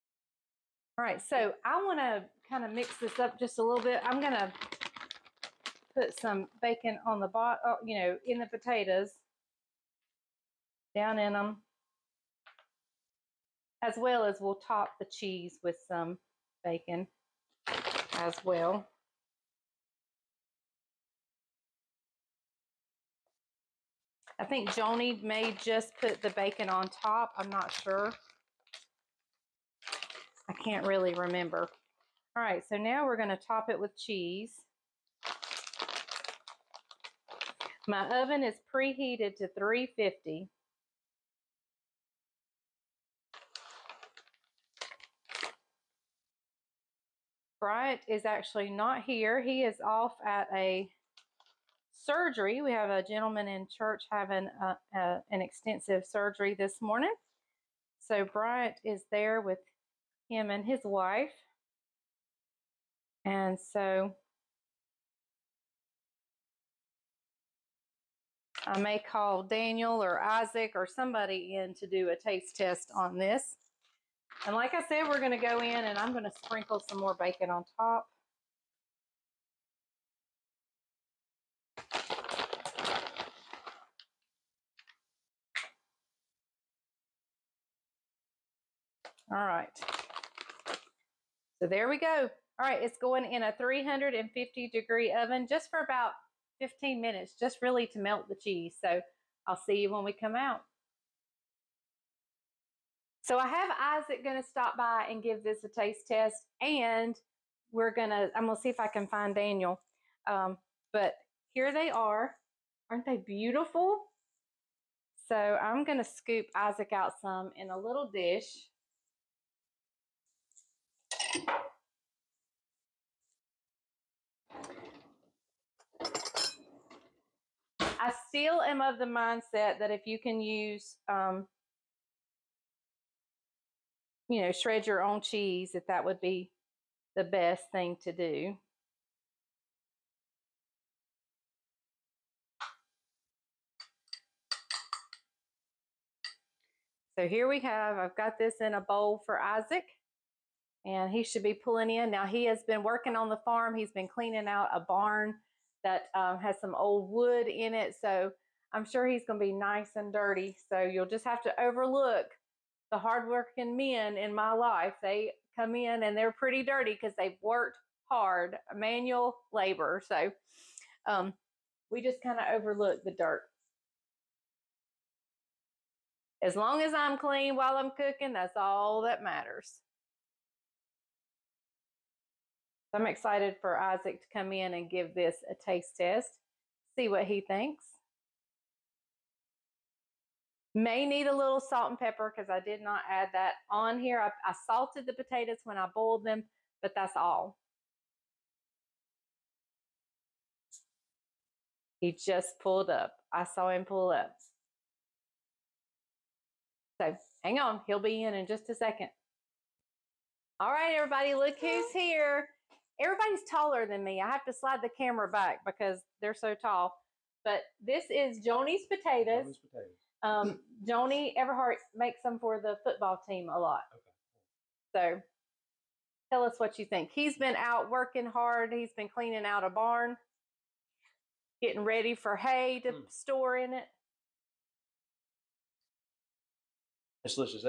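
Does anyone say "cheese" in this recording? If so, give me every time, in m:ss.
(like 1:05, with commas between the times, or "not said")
0:15, 0:33, 1:38, 2:15.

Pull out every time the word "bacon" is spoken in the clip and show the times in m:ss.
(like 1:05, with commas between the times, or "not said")
0:06, 0:16, 0:26, 1:17.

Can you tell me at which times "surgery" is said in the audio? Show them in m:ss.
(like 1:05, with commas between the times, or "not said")
0:51, 0:56.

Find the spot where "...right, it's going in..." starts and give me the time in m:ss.
1:32.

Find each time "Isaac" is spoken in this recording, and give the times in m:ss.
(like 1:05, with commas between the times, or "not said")
1:10, 1:43, 1:56, 2:29, 3:03.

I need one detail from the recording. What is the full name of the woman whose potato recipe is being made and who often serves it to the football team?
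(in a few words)
Joni Everhart.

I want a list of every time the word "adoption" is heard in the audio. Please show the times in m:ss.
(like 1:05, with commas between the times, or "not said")
not said.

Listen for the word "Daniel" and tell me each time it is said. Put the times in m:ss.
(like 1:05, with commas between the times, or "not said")
1:09, 1:49.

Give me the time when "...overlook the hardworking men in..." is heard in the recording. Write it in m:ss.
2:41.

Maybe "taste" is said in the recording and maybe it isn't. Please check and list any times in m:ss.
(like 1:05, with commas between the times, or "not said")
1:12, 1:45, 3:05.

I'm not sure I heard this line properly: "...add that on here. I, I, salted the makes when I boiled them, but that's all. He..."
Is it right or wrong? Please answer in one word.
wrong.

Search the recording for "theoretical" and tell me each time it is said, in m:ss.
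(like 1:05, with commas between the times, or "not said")
not said.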